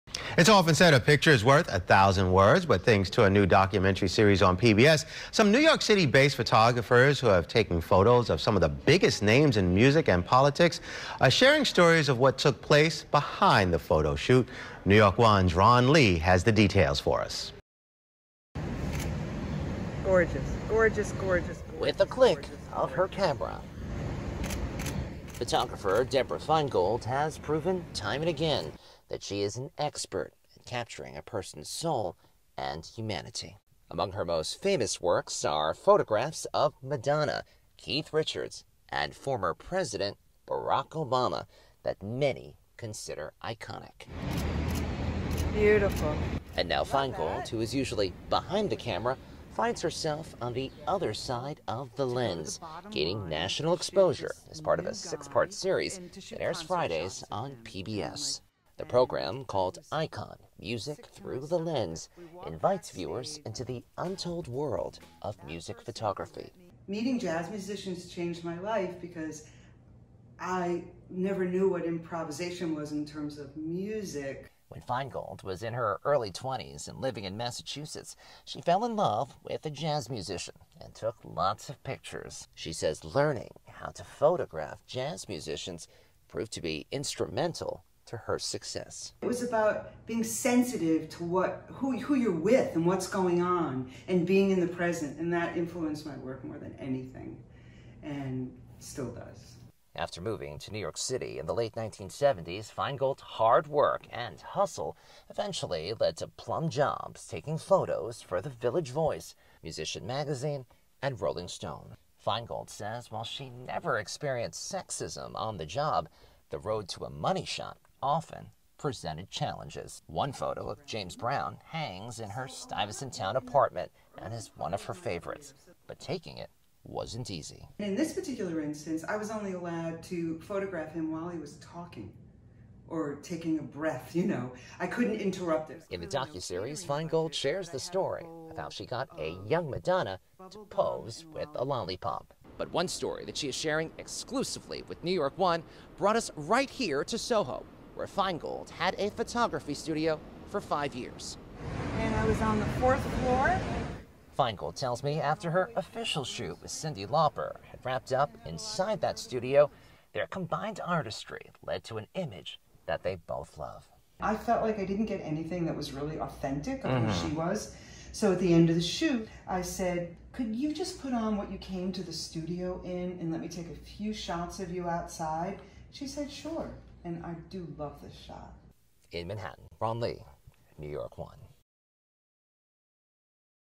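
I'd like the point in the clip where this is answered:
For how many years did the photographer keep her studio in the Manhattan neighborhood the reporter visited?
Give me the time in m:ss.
2:30.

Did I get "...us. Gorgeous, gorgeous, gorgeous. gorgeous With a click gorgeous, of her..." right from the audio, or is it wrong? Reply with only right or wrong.
right.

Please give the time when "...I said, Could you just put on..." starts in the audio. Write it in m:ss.
2:49.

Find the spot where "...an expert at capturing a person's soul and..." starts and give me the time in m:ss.
0:29.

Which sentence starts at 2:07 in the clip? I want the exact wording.
In this particular instance, I was only allowed to photograph him while he was talking or taking a breath, you know.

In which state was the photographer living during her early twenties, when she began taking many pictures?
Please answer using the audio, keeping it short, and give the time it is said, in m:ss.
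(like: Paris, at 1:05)
Massachusetts, at 1:17.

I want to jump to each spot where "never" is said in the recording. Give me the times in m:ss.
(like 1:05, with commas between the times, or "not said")
1:11, 1:53.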